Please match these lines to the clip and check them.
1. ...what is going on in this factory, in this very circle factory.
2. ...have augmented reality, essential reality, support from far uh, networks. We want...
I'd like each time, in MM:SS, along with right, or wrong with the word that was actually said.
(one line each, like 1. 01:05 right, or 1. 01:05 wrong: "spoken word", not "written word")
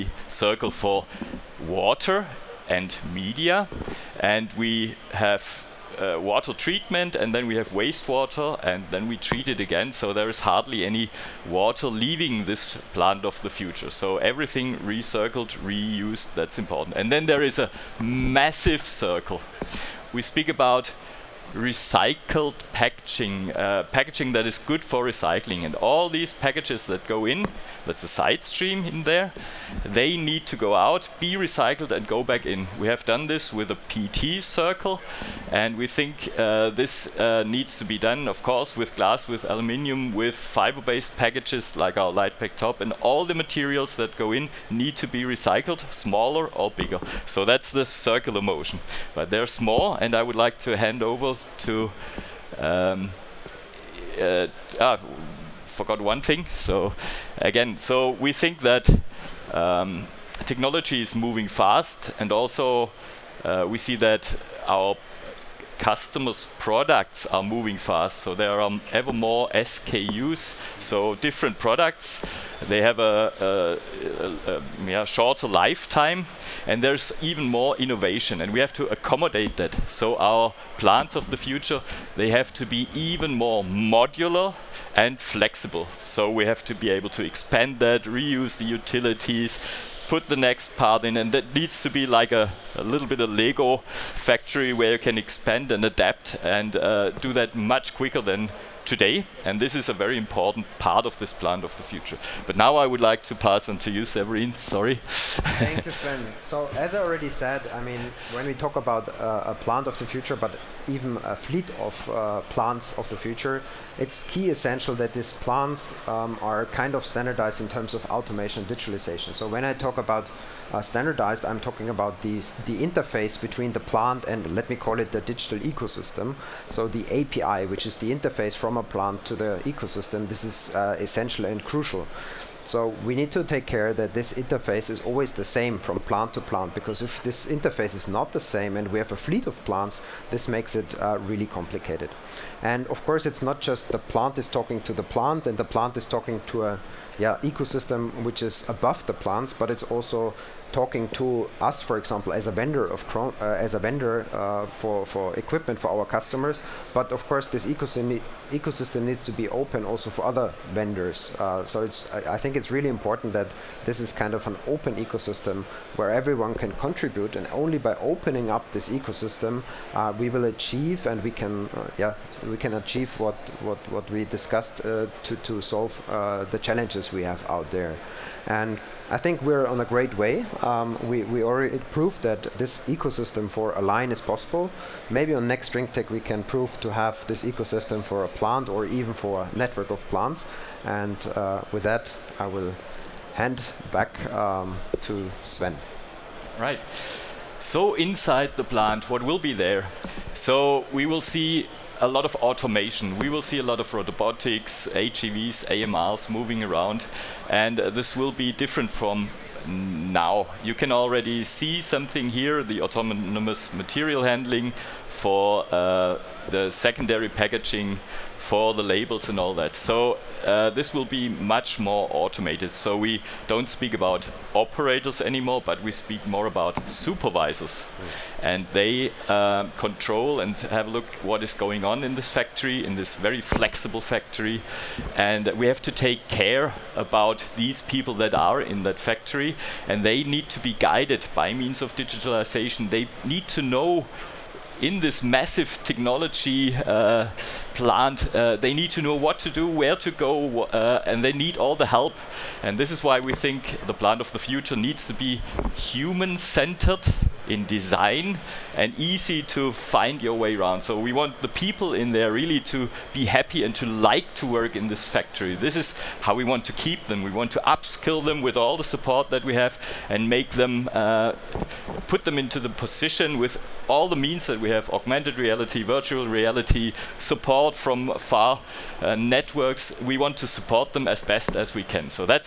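1. 03:51 wrong: "flexible", not "circle"
2. 04:34 wrong: "virtual", not "essential".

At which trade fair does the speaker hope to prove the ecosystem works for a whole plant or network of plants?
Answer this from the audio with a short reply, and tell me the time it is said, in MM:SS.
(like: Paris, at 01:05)
drinktec, at 03:05.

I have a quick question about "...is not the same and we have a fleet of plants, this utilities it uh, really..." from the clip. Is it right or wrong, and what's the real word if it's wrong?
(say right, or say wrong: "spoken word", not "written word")
wrong: "makes", not "utilities".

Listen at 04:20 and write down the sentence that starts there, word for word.
So we want the people in there really to be happy and to like to work in this factory.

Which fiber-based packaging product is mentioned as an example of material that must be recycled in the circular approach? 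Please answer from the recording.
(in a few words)
LitePac Top.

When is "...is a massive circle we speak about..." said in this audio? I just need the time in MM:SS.
00:17.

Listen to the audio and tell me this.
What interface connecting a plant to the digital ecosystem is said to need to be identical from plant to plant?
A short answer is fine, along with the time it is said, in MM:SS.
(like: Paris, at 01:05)
API, at 02:07.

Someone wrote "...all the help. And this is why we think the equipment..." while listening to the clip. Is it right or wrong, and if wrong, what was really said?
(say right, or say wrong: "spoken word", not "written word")
wrong: "plant", not "equipment".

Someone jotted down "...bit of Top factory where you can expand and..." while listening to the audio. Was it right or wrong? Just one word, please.
wrong.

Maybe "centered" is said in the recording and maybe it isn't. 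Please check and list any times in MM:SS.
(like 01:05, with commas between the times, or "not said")
04:15.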